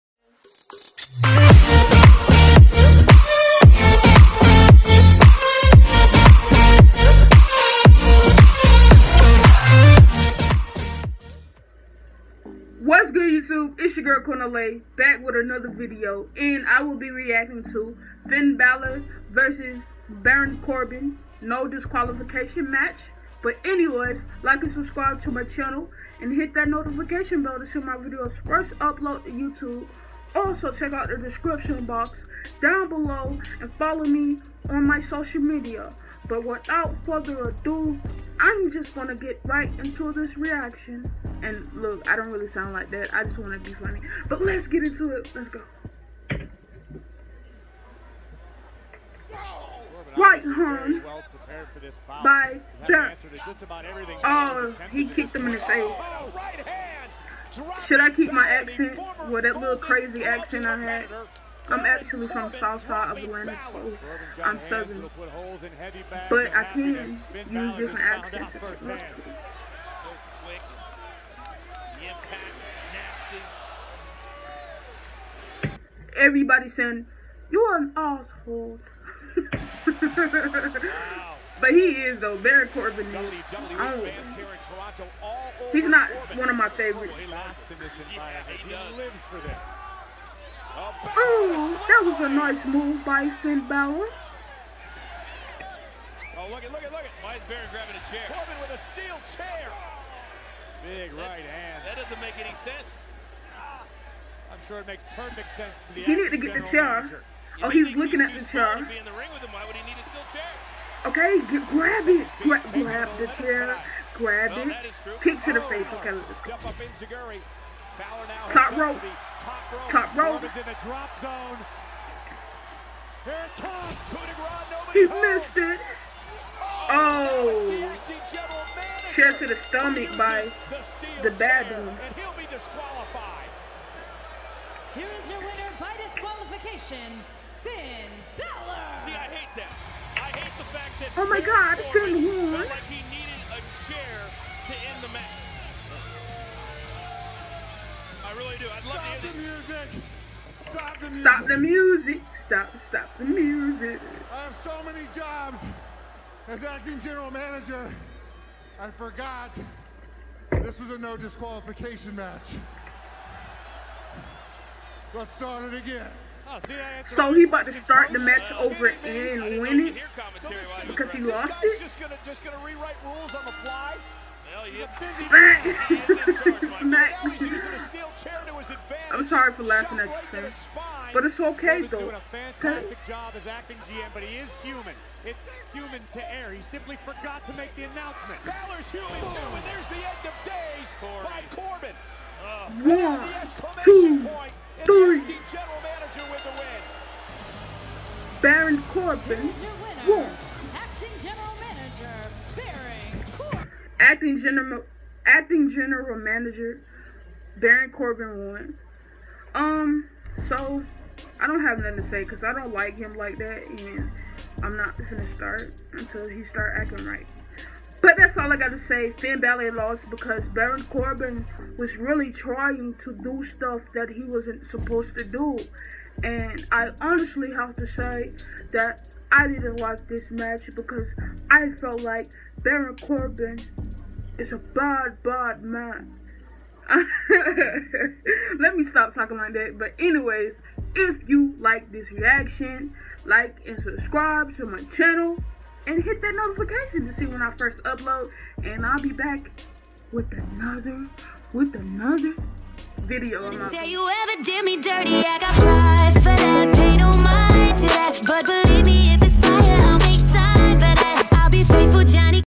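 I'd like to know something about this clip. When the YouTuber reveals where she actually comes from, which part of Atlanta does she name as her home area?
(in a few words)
South side.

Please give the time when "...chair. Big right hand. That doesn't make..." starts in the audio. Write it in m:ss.
1:39.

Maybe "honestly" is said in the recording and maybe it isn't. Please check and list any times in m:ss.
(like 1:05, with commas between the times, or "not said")
3:46.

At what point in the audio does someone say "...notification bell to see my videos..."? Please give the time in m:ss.
0:26.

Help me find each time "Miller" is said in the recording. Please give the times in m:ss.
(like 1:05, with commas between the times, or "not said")
not said.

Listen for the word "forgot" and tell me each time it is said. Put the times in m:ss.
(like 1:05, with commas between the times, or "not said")
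2:38, 3:07.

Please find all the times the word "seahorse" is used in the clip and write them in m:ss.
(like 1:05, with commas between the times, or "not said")
not said.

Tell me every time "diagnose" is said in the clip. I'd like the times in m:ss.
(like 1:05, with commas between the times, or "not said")
not said.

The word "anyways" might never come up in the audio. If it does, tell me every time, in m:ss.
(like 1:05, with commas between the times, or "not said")
0:23, 3:59.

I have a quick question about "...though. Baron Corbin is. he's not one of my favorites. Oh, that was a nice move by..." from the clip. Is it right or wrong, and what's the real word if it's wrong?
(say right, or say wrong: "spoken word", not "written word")
right.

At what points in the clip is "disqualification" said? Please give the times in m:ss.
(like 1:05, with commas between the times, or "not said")
0:21, 2:16, 2:41.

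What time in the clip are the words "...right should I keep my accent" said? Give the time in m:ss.
0:56.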